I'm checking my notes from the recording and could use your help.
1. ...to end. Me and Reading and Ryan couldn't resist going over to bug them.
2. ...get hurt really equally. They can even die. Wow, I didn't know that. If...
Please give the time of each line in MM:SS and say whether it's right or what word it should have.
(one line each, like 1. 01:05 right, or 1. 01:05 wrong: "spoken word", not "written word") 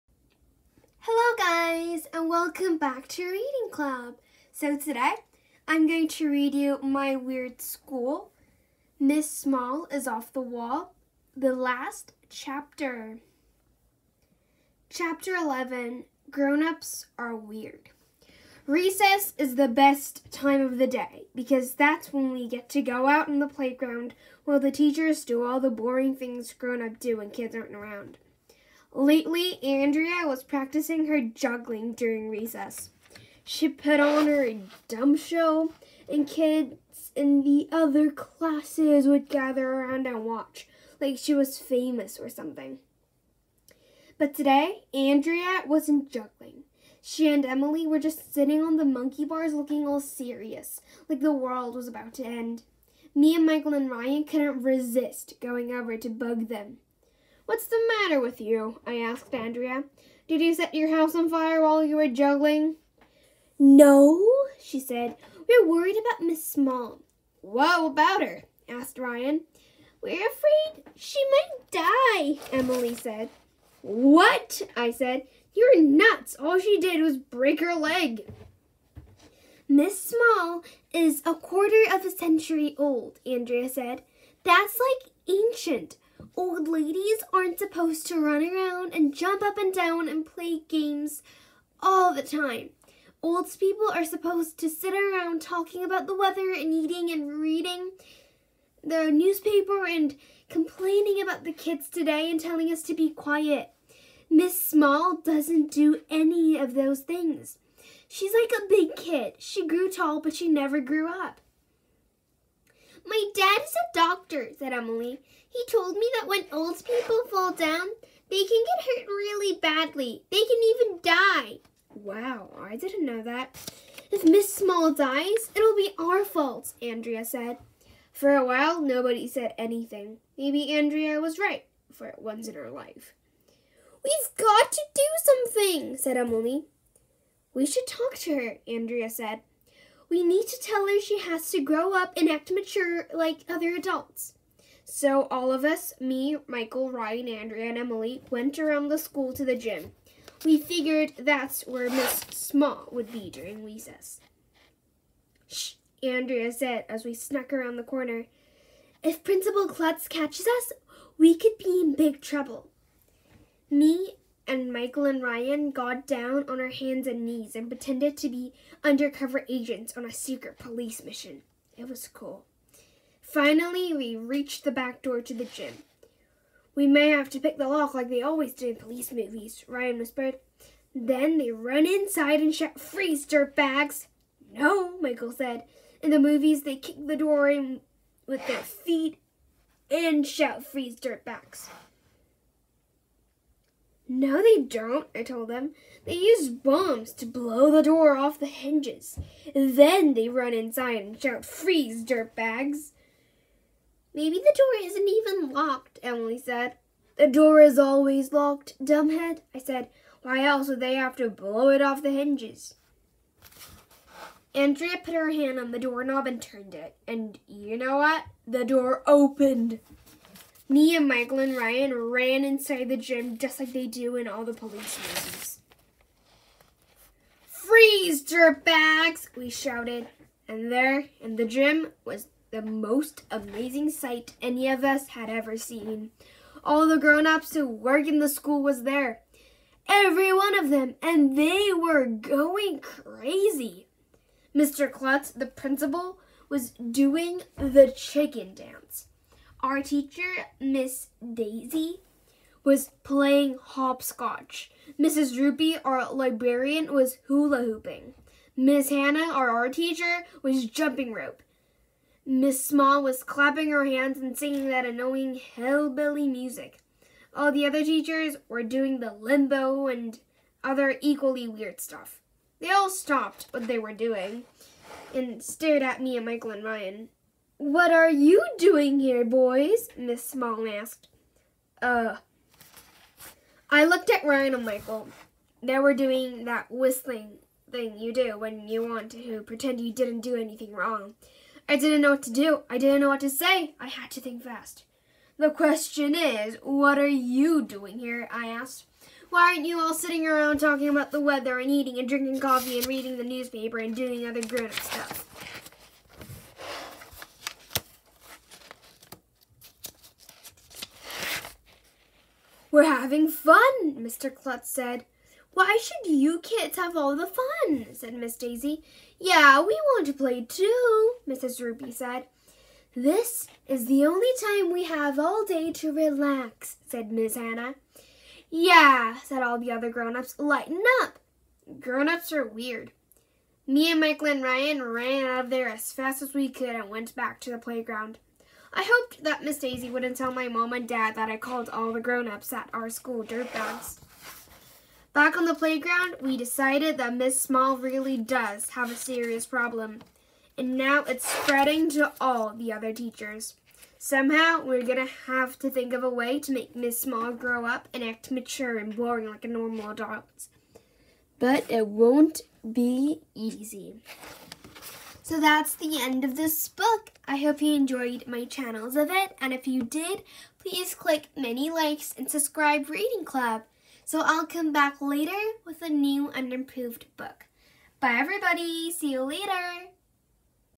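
1. 00:52 wrong: "Michael", not "Reading"
2. 01:58 wrong: "badly", not "equally".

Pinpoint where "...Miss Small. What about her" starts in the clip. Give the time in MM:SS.
01:06.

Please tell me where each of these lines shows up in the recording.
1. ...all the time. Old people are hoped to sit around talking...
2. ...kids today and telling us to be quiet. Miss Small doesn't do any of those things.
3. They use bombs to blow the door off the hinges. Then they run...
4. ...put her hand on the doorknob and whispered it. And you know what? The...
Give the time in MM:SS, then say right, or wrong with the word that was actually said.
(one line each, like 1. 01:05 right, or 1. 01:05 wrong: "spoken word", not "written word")
1. 01:31 wrong: "supposed", not "hoped"
2. 01:41 right
3. 03:16 right
4. 03:35 wrong: "turned", not "whispered".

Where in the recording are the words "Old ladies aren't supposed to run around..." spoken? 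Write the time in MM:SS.
01:26.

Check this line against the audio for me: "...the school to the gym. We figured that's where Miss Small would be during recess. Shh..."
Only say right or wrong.
right.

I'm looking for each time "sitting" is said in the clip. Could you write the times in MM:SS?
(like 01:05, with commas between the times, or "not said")
00:48, 04:59.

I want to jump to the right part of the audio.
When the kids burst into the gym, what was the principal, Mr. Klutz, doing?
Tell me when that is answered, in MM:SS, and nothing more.
04:07.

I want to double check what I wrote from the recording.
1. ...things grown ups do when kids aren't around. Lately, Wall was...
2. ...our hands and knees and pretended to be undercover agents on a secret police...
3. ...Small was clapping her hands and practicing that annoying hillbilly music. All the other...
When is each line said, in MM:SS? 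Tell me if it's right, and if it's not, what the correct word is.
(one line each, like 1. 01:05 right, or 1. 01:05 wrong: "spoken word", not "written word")
1. 00:26 wrong: "Andrea", not "Wall"
2. 02:46 right
3. 04:22 wrong: "singing", not "practicing".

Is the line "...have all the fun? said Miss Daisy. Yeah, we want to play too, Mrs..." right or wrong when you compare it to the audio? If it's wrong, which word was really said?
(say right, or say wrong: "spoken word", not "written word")
right.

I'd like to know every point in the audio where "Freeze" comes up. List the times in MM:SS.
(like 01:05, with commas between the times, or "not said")
03:02, 03:10, 03:21, 03:47.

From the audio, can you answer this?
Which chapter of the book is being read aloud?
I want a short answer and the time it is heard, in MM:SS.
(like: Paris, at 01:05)
11, at 00:14.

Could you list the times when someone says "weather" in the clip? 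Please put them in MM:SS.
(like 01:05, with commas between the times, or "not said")
01:36, 05:01.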